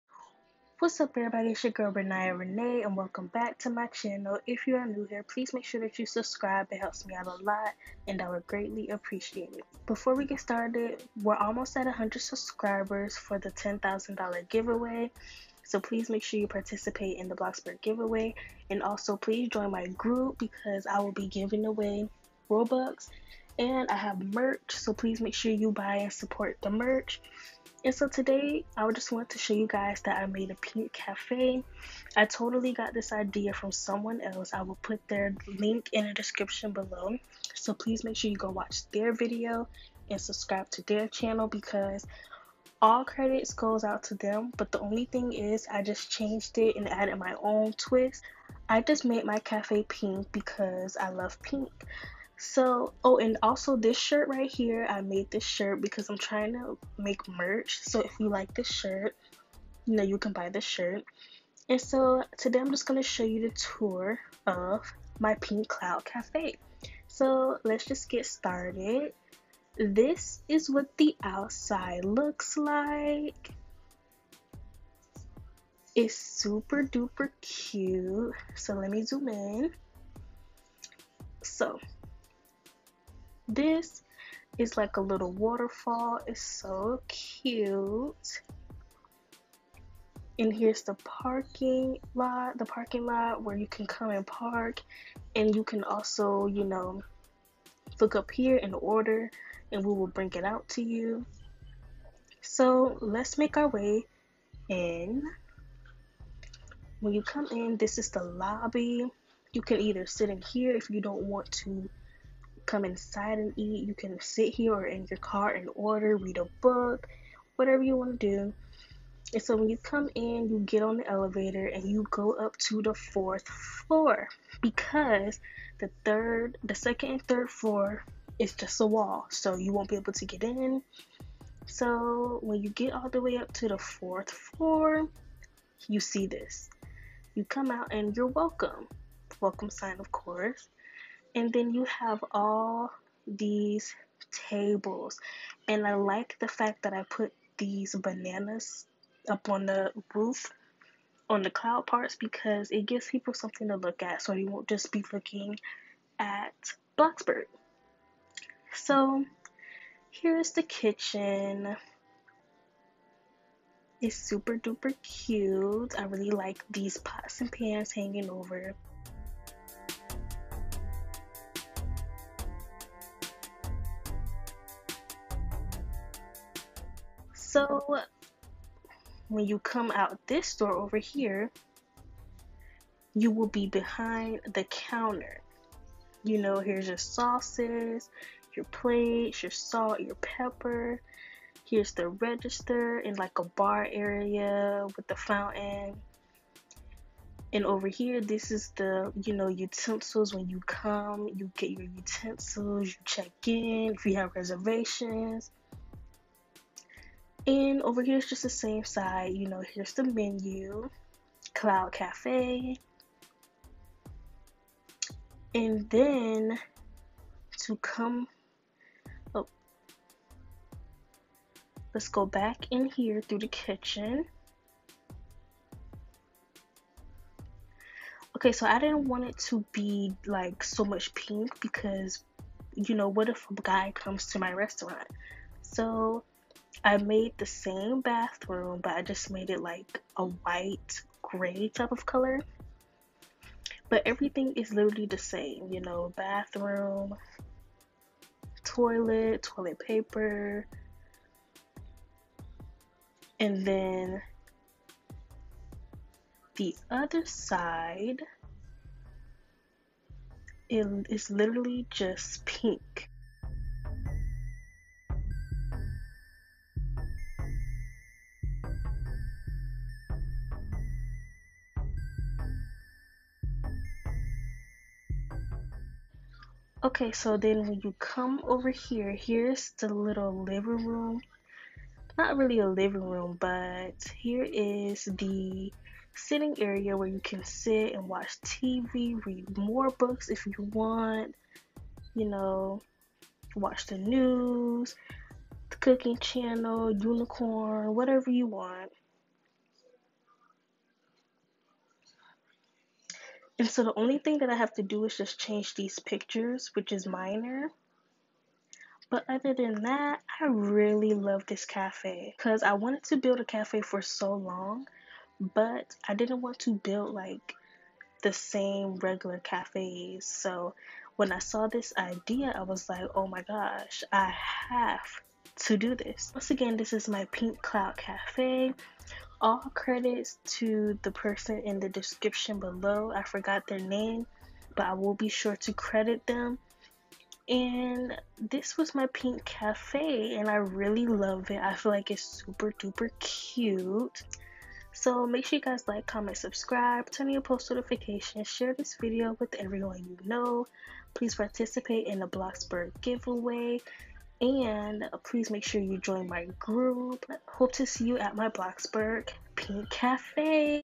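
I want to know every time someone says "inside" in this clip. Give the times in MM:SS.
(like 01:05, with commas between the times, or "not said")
01:52.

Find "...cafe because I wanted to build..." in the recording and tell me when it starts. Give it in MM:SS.
05:11.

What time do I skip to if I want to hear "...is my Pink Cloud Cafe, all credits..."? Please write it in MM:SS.
05:26.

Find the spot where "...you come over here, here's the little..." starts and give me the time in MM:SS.
04:37.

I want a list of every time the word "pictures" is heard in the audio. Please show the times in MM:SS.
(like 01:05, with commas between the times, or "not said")
05:05.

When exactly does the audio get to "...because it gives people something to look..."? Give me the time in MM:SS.
02:32.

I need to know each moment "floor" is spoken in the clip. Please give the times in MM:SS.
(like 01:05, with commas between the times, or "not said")
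02:03, 02:07, 02:14.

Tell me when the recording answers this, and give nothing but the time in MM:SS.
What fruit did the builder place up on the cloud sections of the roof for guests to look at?
02:27.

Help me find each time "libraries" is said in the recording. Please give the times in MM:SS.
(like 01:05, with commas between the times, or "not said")
not said.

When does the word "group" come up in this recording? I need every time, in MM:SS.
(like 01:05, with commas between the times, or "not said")
00:19, 05:56.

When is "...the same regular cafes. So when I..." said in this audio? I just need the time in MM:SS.
05:18.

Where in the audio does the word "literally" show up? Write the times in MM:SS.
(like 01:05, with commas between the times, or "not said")
04:04, 04:21.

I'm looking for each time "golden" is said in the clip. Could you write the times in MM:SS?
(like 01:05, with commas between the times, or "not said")
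not said.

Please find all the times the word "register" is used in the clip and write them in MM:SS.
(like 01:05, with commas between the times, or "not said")
03:12.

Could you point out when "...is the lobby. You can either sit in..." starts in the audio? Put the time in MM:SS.
01:47.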